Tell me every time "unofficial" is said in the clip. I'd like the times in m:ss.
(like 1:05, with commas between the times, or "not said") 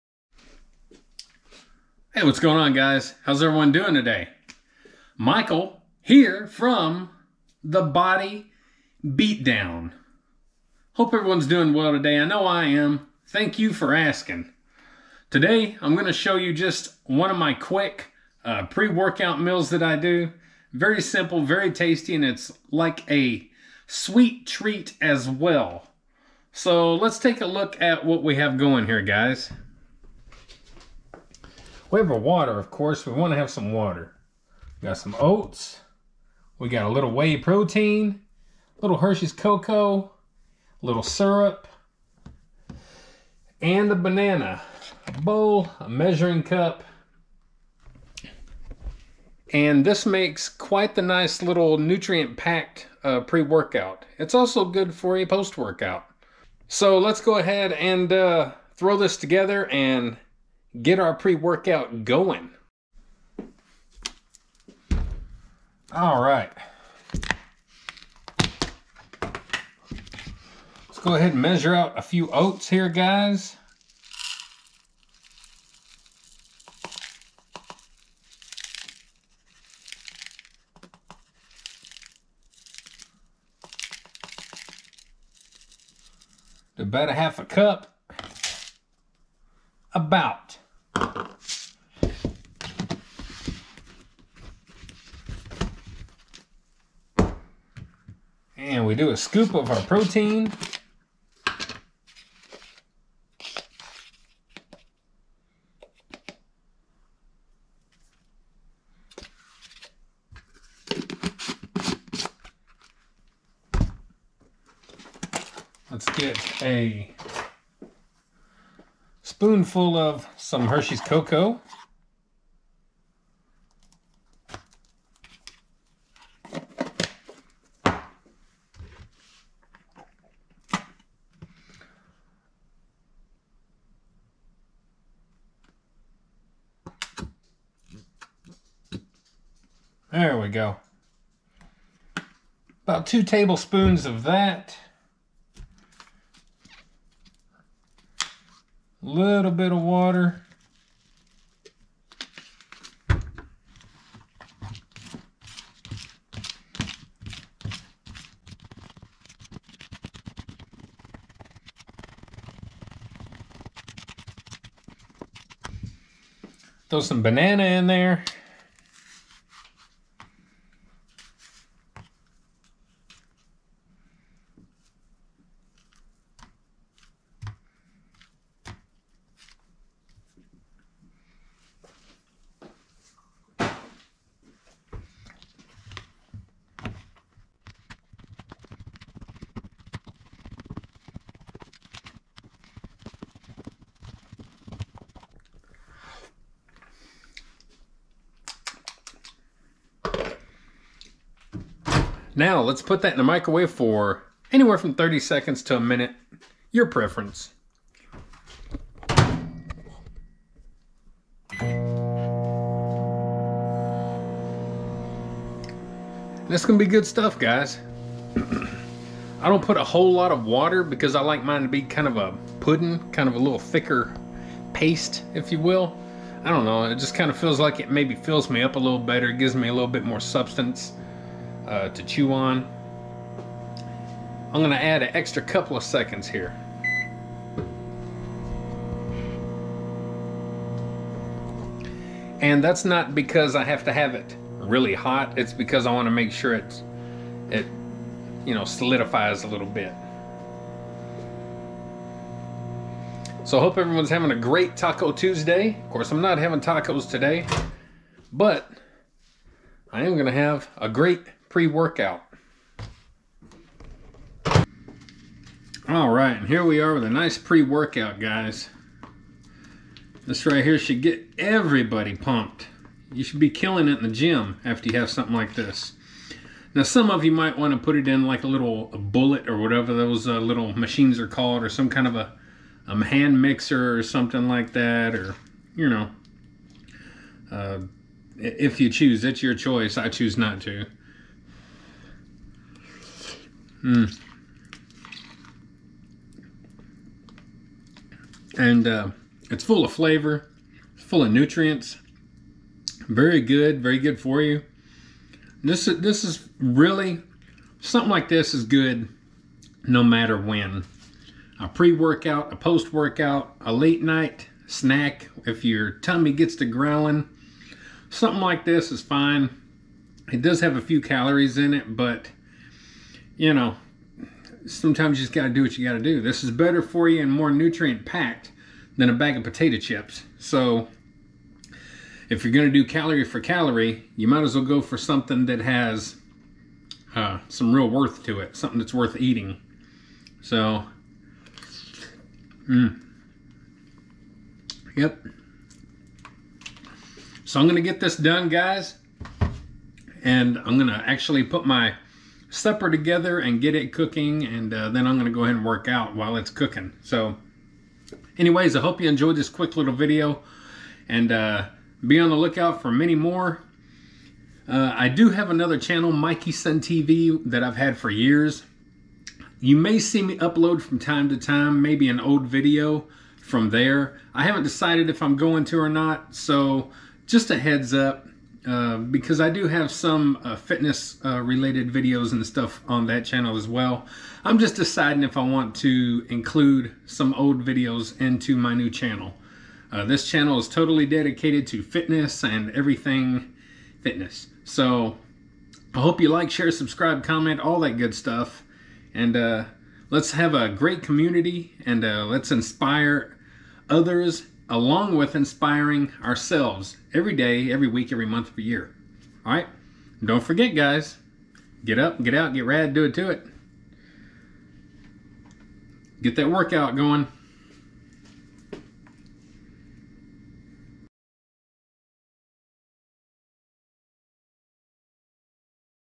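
not said.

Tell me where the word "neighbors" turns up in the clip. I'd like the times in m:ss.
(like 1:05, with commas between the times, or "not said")
not said.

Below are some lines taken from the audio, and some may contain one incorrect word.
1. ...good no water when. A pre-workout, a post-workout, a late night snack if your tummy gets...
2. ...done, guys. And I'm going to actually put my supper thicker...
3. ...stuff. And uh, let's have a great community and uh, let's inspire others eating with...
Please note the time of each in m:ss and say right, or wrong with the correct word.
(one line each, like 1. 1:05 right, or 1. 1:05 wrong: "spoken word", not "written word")
1. 5:08 wrong: "matter", not "water"
2. 5:48 wrong: "together", not "thicker"
3. 6:38 wrong: "along", not "eating".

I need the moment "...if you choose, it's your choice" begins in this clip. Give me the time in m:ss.
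4:48.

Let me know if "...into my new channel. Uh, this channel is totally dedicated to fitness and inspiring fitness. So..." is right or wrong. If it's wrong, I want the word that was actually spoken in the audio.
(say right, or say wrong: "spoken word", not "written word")
wrong: "everything", not "inspiring".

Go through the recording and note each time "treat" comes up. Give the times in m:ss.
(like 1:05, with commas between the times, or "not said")
0:24.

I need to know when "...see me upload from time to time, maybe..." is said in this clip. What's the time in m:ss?
6:09.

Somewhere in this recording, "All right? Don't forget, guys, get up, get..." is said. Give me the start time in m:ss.
6:49.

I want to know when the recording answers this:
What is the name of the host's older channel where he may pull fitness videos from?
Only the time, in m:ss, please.
6:06.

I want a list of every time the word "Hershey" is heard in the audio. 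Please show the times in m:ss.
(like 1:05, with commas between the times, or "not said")
0:38, 2:00.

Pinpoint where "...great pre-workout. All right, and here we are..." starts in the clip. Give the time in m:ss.
4:20.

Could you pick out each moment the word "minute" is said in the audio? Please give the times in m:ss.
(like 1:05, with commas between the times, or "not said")
3:25.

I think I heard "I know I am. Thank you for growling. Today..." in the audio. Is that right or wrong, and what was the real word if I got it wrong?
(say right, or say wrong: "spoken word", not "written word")
wrong: "asking", not "growling".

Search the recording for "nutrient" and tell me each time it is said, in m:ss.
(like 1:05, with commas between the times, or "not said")
0:51, 5:01, 5:27.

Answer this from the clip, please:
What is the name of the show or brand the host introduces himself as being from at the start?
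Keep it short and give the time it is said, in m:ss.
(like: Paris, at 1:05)
Body Beatdown, at 0:07.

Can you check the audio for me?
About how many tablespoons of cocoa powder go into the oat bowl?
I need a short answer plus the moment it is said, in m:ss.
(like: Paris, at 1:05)
2, at 2:23.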